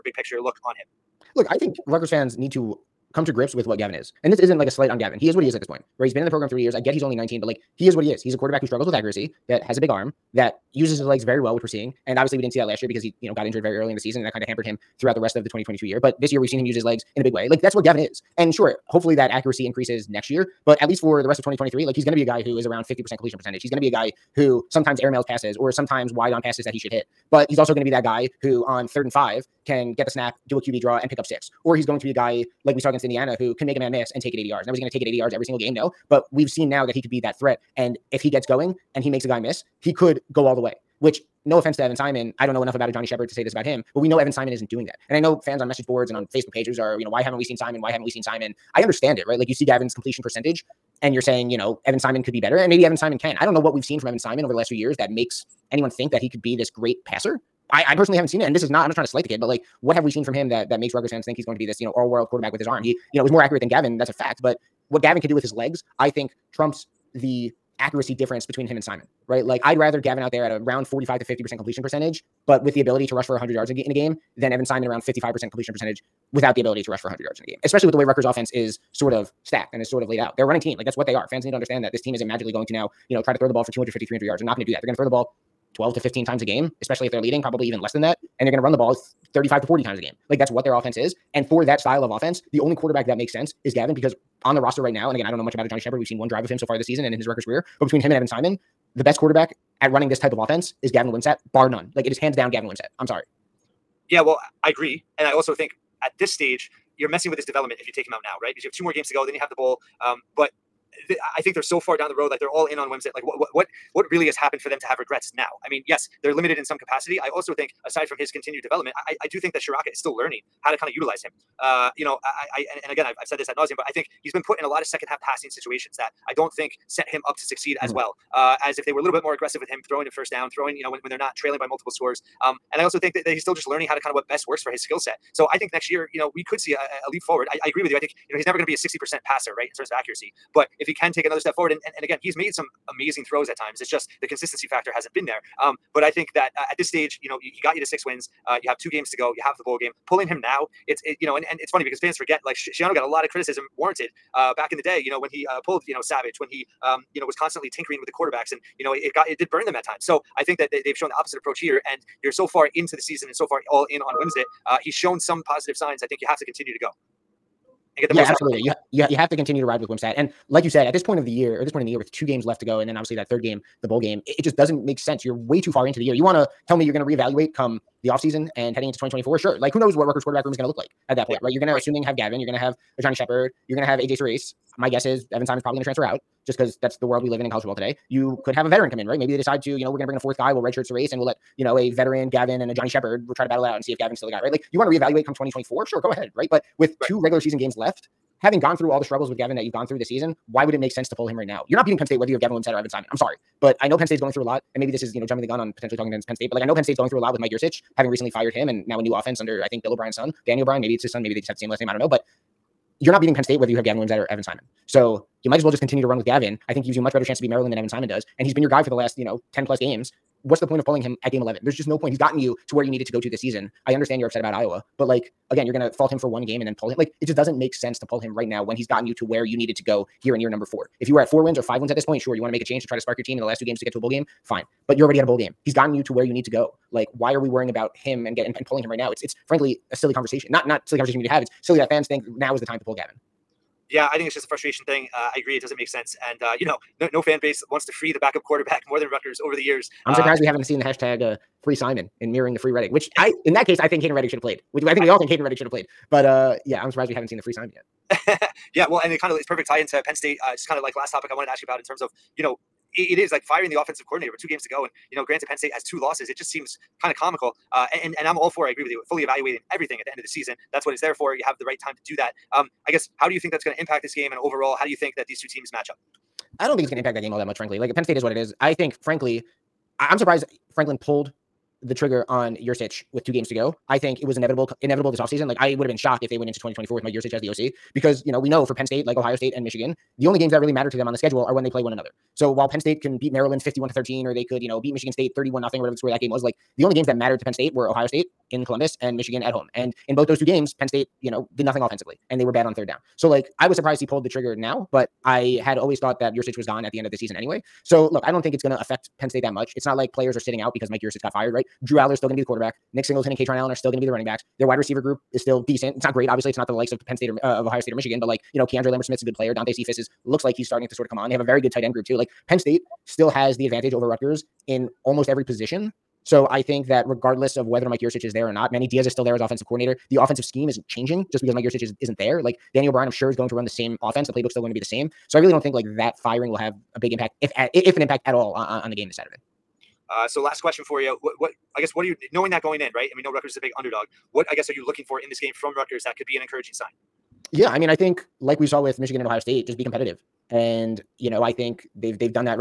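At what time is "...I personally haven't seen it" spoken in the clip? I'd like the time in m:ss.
0:57.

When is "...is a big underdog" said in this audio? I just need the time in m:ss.
5:43.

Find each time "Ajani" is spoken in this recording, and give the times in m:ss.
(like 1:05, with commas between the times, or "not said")
0:42, 1:35, 3:02, 3:12.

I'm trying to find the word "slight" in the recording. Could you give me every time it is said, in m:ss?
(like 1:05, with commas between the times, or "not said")
0:04, 0:59.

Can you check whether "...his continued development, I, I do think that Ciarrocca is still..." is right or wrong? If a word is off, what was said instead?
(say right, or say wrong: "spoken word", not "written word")
right.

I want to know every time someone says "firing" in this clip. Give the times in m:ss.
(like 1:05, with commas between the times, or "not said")
4:23, 5:36.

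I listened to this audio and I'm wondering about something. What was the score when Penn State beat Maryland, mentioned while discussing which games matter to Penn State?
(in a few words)
51 to 13.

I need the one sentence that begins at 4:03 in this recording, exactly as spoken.
Yeah, I think it's just a frustration thing.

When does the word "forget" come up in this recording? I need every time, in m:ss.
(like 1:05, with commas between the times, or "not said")
2:32.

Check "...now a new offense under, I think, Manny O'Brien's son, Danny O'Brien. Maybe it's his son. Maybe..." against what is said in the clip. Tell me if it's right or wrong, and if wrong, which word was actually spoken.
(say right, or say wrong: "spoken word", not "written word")
wrong: "Bill", not "Manny".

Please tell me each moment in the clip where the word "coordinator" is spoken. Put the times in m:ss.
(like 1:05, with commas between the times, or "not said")
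4:24, 5:29.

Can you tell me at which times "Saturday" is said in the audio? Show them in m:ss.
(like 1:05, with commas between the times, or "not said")
5:39.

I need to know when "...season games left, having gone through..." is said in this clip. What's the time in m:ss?
3:17.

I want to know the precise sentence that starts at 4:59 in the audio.
And in both those two games, Penn State, you know, did nothing offensively and they were bad on third down.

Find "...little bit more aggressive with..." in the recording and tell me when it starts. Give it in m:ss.
2:09.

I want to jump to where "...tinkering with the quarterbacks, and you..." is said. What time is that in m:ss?
2:37.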